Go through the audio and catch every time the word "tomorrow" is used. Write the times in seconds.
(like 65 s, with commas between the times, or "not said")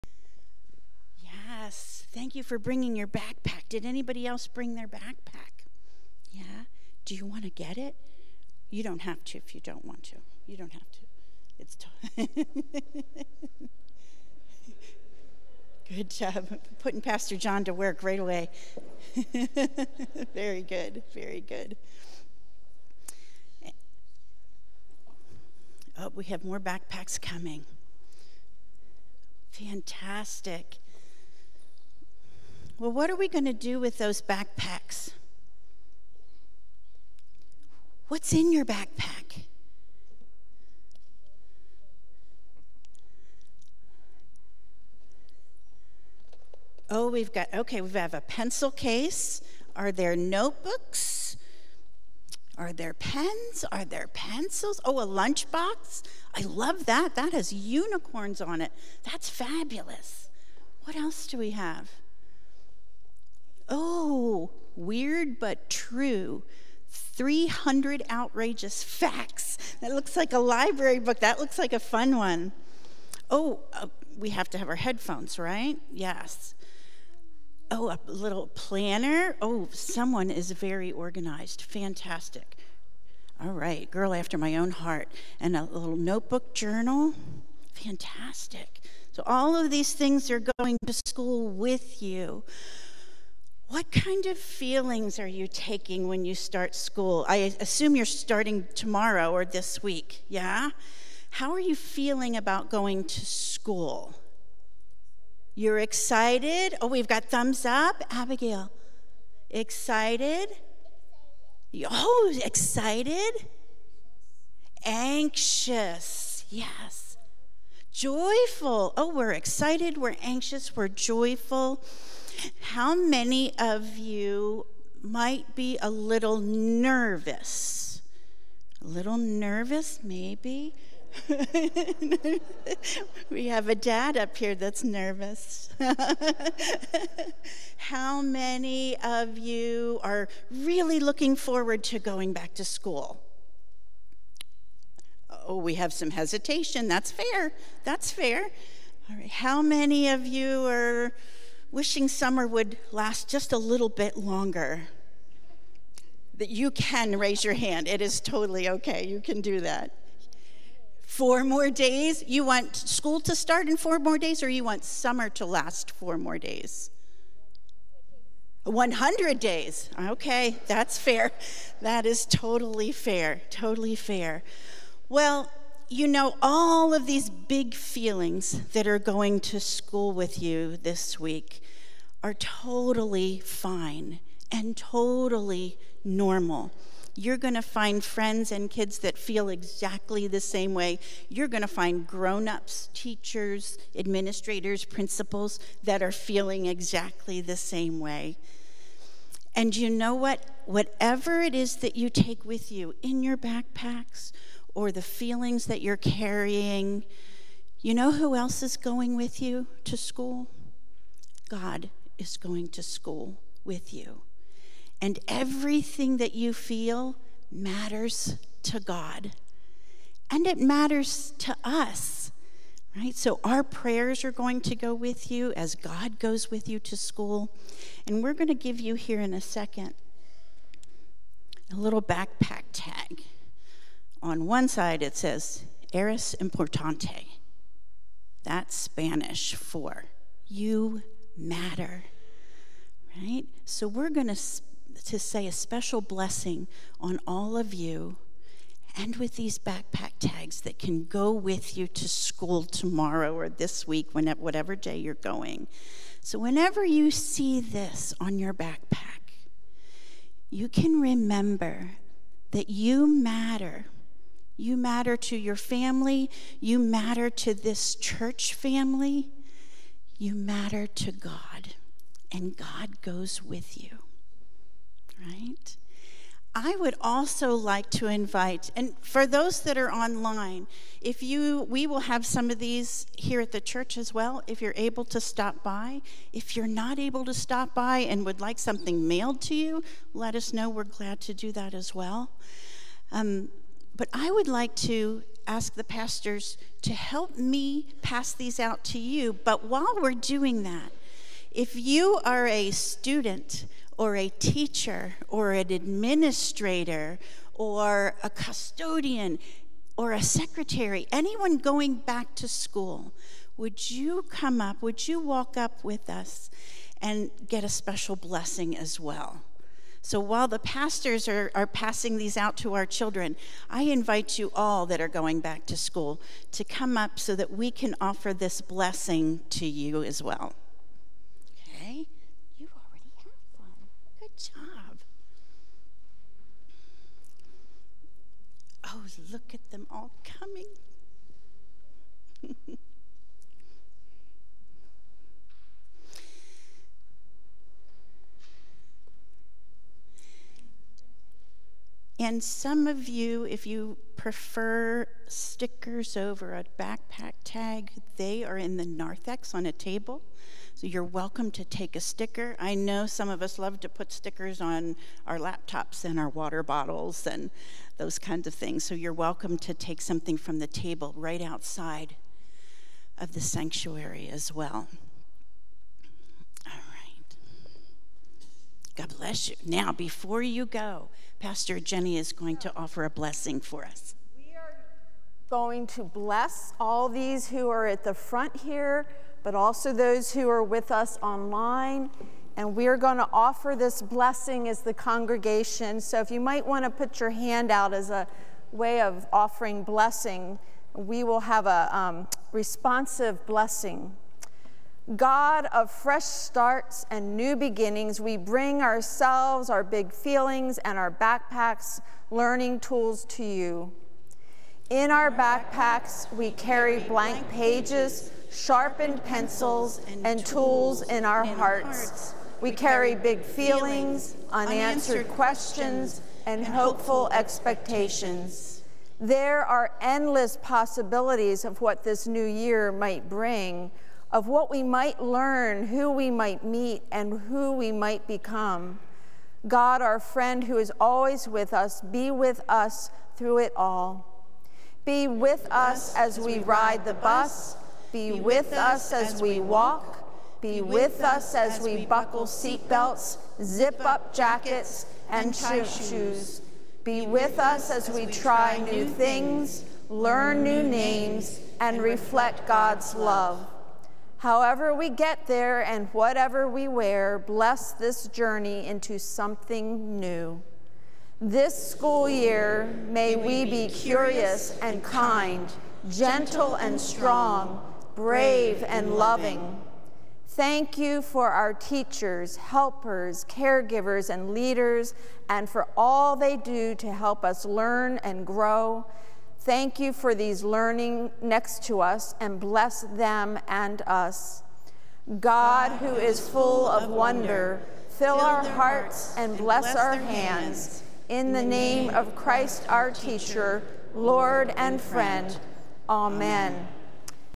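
98 s, 252 s.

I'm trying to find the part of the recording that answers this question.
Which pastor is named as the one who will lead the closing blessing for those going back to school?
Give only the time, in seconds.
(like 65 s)
381 s.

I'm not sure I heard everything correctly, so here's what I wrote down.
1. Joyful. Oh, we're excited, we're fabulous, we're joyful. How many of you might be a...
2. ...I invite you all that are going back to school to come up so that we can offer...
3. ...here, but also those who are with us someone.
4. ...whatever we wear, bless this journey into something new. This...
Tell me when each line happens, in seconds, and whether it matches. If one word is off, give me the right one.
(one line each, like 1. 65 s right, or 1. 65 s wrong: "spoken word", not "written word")
1. 117 s wrong: "anxious", not "fabulous"
2. 323 s right
3. 388 s wrong: "online", not "someone"
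4. 466 s right.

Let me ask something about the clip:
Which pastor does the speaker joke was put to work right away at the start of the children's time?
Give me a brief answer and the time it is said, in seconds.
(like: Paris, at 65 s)
Pastor John, at 17 s.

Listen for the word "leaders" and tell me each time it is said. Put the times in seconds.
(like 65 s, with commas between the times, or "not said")
484 s.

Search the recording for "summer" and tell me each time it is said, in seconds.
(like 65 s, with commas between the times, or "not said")
152 s, 164 s.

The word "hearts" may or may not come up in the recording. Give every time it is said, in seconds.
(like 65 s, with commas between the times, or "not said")
84 s, 421 s, 498 s.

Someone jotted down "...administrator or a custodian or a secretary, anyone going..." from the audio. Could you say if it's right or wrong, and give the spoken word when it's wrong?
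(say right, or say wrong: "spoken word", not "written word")
right.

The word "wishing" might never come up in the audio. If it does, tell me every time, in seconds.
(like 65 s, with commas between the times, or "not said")
151 s.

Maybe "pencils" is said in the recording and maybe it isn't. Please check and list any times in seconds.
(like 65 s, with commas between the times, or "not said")
48 s, 54 s, 419 s.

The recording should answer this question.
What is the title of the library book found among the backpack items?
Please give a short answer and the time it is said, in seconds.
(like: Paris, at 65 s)
Weird But True 300 Outrageous Facts, at 64 s.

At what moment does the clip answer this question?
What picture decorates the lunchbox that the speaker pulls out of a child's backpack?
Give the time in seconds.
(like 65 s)
57 s.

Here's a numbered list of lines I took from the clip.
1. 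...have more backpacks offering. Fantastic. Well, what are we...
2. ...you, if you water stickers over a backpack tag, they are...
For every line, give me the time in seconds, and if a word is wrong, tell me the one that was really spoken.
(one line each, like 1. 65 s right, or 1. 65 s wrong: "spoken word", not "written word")
1. 26 s wrong: "coming", not "offering"
2. 353 s wrong: "prefer", not "water".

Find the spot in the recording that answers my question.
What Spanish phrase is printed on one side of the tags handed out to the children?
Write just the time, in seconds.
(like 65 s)
235 s.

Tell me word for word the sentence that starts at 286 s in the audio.
If you're not able to stop by and would like something mailed to you, let us know.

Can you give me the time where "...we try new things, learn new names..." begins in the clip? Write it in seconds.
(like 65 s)
458 s.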